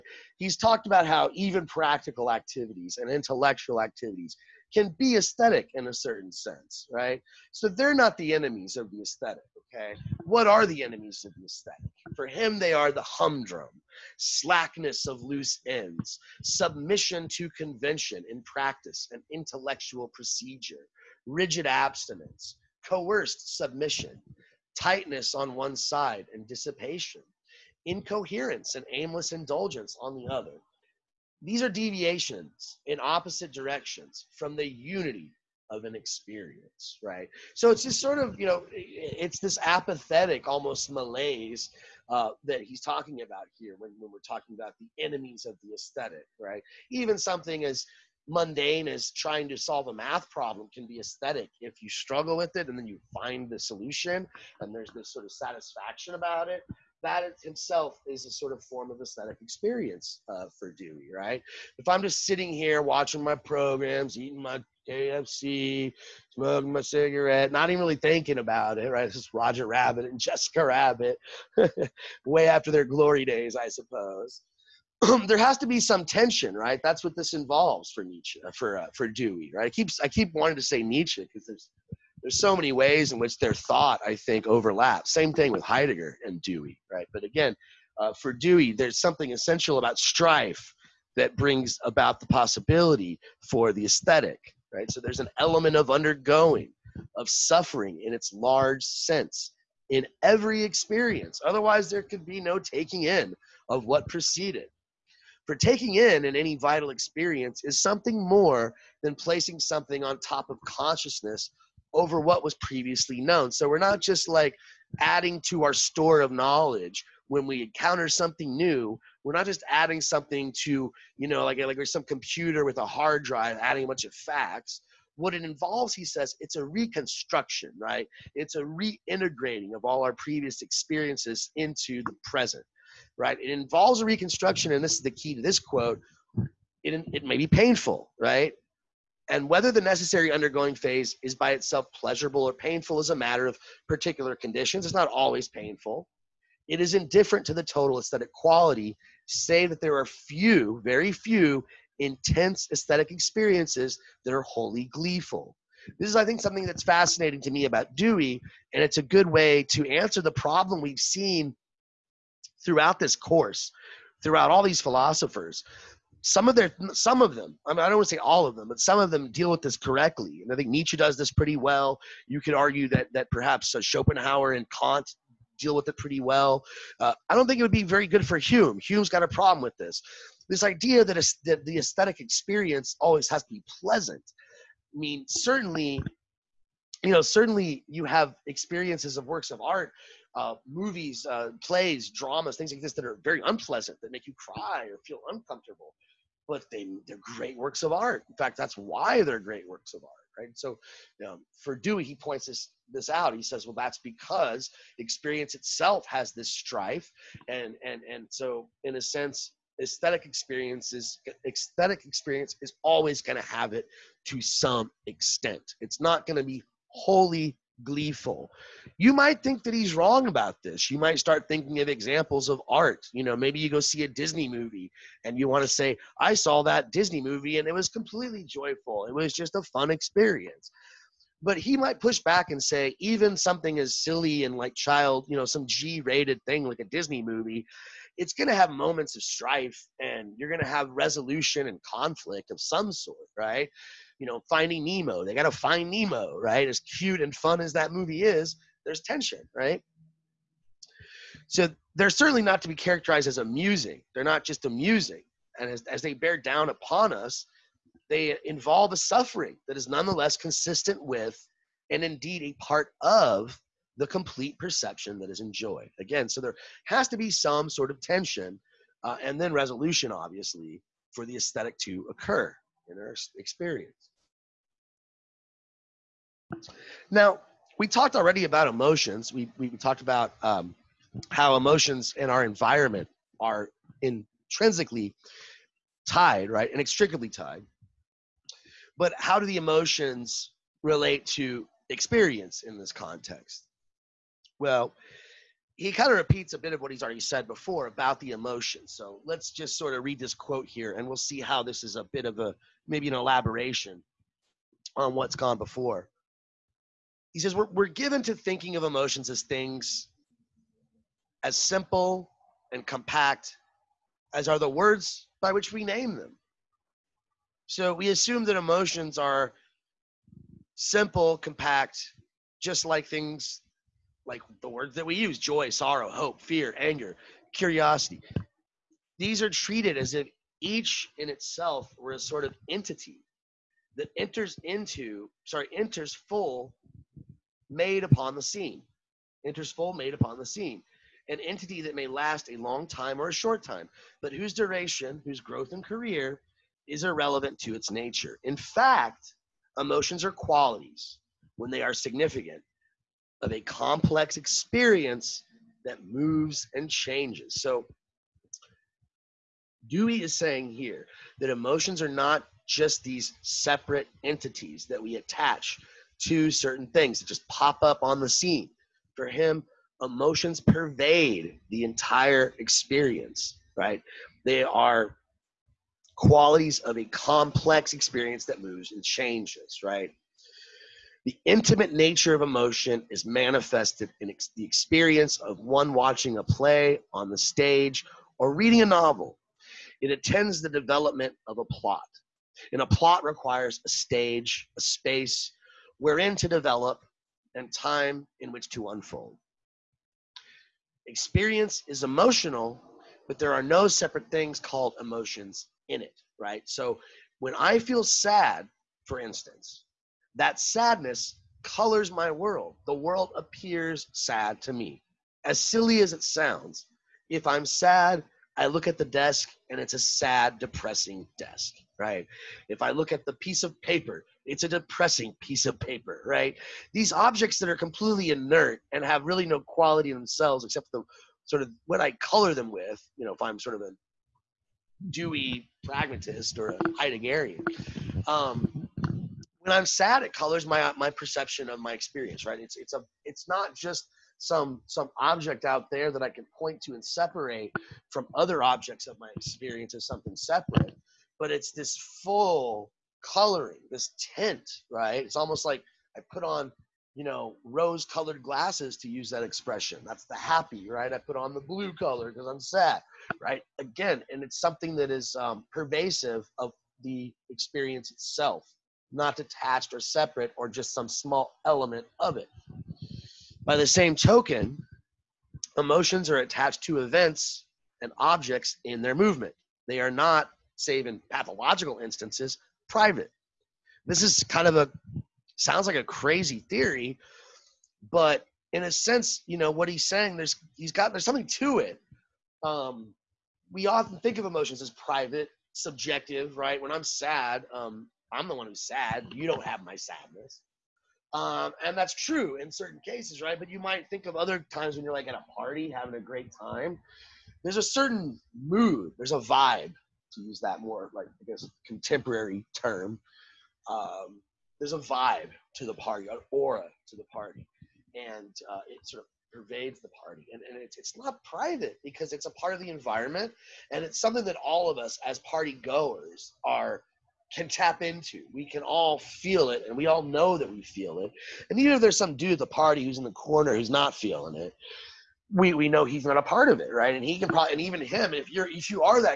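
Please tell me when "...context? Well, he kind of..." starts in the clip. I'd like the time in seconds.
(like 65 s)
292 s.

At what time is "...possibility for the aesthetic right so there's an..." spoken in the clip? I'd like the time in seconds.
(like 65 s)
92 s.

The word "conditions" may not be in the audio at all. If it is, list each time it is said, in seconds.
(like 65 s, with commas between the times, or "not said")
144 s.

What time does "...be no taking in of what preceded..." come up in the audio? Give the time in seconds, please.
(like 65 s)
102 s.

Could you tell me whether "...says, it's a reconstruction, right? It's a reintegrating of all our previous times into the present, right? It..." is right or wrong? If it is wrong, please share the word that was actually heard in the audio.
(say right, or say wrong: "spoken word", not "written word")
wrong: "experiences", not "times".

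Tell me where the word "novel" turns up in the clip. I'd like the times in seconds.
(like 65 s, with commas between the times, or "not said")
388 s.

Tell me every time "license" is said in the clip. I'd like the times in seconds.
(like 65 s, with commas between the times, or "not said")
not said.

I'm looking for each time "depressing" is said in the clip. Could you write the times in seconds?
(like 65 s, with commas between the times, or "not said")
420 s, 424 s.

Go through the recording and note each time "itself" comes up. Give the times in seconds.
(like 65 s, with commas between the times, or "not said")
141 s, 205 s, 331 s, 468 s.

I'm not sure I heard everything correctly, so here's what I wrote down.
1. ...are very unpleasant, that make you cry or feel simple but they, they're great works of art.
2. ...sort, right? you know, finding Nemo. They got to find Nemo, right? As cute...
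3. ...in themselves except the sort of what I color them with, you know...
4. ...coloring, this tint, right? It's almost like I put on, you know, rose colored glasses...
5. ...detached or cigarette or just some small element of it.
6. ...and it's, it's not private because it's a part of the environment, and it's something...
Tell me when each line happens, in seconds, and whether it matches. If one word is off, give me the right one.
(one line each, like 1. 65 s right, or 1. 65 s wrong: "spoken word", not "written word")
1. 193 s wrong: "uncomfortable", not "simple"
2. 242 s right
3. 430 s right
4. 453 s right
5. 469 s wrong: "separate", not "cigarette"
6. 520 s right.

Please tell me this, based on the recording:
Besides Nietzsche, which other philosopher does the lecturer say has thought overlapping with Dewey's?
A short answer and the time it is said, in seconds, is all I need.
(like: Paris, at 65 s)
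Heidegger, at 85 s.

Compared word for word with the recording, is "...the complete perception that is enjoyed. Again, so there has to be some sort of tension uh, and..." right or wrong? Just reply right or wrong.
right.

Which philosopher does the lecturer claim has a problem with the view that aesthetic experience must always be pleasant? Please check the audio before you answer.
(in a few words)
Hume.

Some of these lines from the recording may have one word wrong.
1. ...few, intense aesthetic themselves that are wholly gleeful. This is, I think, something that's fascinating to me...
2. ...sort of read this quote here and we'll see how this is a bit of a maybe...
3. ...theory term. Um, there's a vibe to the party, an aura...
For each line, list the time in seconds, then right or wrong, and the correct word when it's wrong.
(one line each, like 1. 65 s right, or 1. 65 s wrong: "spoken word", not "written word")
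1. 151 s wrong: "experiences", not "themselves"
2. 299 s right
3. 511 s wrong: "contemporary", not "theory".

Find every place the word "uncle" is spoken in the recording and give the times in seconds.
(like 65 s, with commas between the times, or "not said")
not said.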